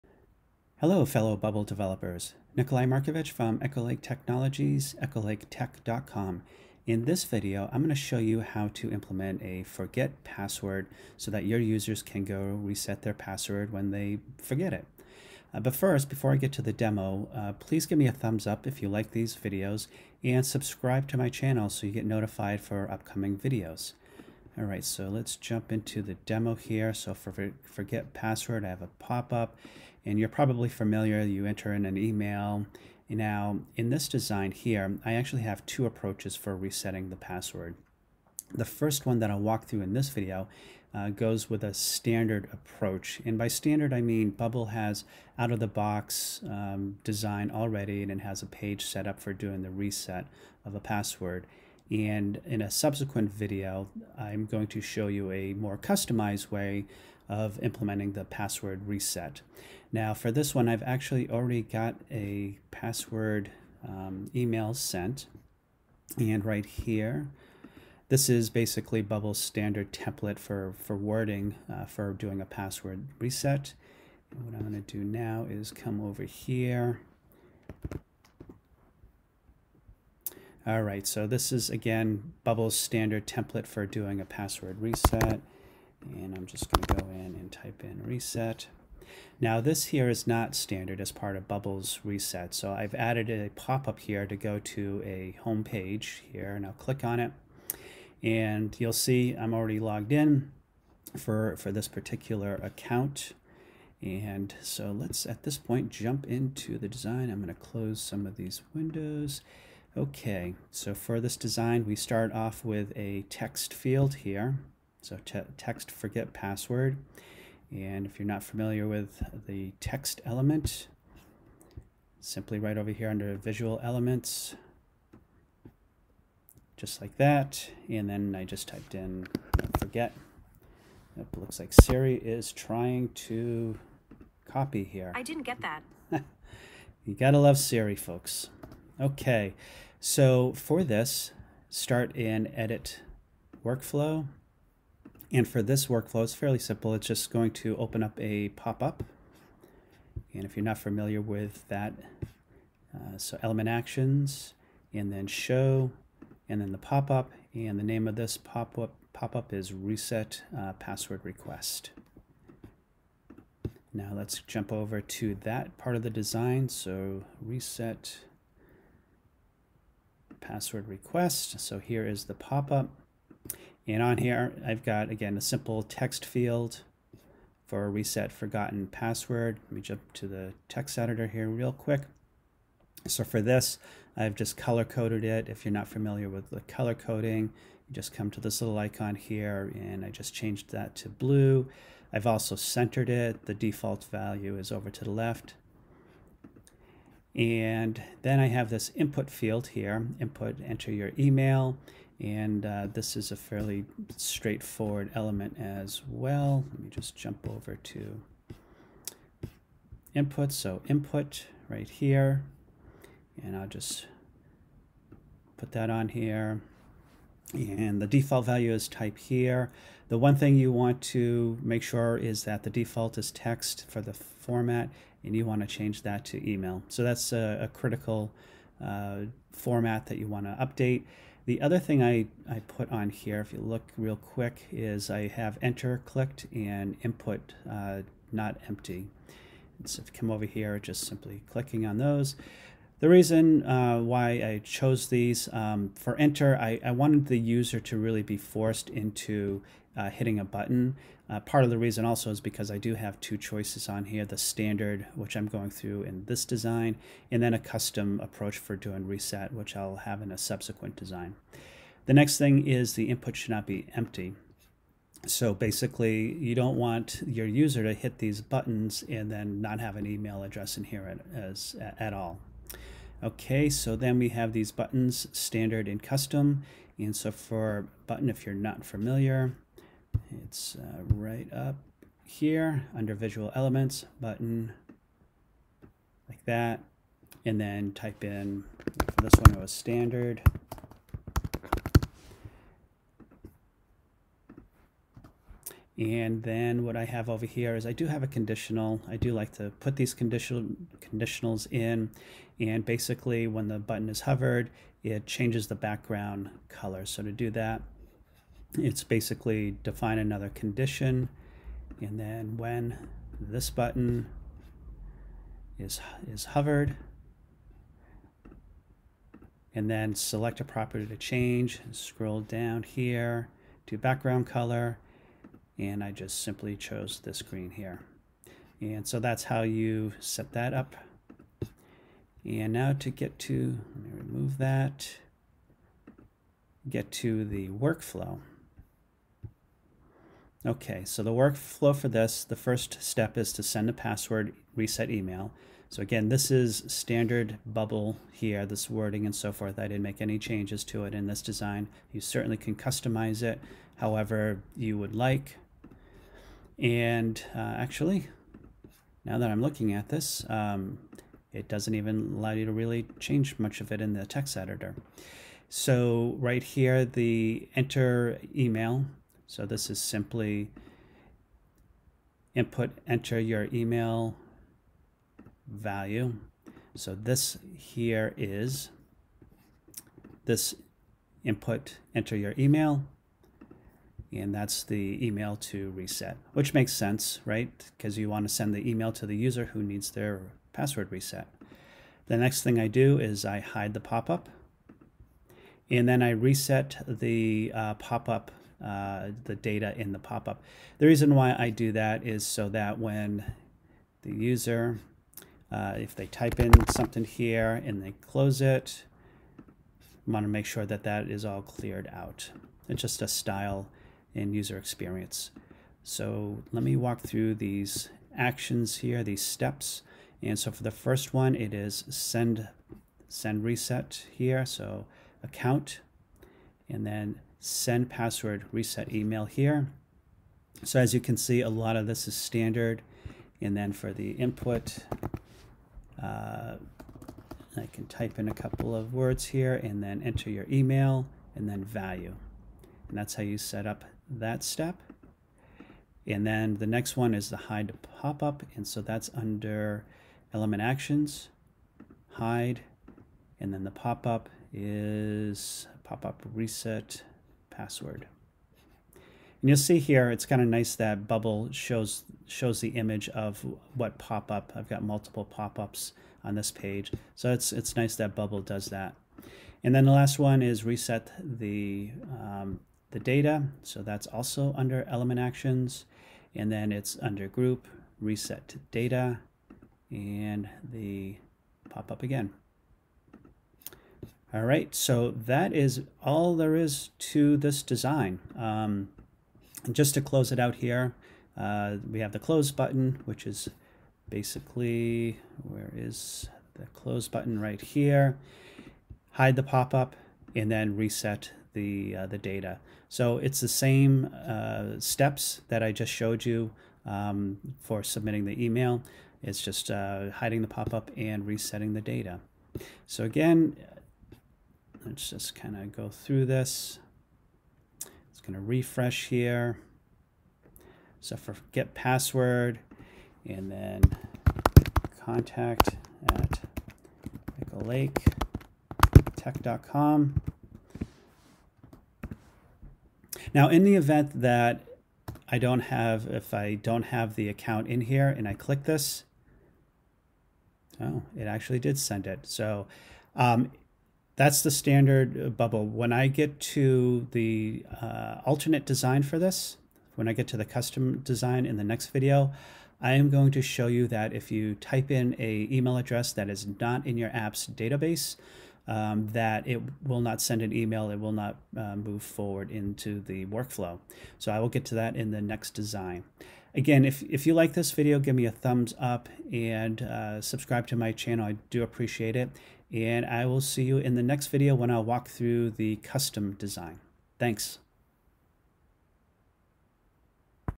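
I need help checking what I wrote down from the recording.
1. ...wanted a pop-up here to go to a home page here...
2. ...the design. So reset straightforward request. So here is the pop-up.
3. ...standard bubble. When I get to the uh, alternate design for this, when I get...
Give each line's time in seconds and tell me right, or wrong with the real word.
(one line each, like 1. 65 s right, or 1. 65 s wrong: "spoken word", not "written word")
1. 92 s wrong: "added", not "wanted"
2. 166 s wrong: "password", not "straightforward"
3. 544 s right.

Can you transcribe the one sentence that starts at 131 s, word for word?
It looks like Siri is trying to copy here.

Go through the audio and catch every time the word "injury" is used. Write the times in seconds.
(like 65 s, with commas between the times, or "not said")
not said.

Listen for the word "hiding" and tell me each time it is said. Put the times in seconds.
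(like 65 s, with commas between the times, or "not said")
510 s.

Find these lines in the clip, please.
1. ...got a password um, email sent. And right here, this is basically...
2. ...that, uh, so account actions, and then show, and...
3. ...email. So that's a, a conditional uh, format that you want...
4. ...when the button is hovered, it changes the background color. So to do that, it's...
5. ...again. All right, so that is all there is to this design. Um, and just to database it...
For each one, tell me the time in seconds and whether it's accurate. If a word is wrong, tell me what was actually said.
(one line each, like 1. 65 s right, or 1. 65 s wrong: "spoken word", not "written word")
1. 61 s right
2. 151 s wrong: "element", not "account"
3. 226 s wrong: "critical", not "conditional"
4. 303 s right
5. 482 s wrong: "close", not "database".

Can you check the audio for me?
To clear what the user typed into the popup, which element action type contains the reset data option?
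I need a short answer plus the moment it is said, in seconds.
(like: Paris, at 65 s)
group, at 477 s.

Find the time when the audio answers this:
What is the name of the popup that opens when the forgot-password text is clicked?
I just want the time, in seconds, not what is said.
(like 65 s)
159 s.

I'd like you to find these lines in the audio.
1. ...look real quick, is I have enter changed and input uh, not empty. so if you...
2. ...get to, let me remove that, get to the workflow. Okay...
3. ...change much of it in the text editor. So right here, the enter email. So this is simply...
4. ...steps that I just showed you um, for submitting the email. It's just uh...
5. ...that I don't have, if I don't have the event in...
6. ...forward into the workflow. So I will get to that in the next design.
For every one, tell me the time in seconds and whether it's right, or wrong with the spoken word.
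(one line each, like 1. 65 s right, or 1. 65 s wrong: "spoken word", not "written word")
1. 233 s wrong: "clicked", not "changed"
2. 333 s right
3. 363 s right
4. 504 s right
5. 534 s wrong: "account", not "event"
6. 562 s right.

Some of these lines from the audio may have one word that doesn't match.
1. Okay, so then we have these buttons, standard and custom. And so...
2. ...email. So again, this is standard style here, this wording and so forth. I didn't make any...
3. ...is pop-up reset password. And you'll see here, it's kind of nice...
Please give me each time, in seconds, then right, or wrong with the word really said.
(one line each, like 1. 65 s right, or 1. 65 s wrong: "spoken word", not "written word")
1. 273 s right
2. 345 s wrong: "bubble", not "style"
3. 454 s right.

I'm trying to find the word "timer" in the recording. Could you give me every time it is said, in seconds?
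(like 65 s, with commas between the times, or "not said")
not said.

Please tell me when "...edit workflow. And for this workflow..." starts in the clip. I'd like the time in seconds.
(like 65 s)
142 s.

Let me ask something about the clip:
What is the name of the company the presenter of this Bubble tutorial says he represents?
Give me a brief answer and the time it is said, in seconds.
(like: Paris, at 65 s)
Lake Technologies, at 3 s.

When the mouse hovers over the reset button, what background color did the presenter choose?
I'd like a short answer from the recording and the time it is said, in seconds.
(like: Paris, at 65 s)
green, at 327 s.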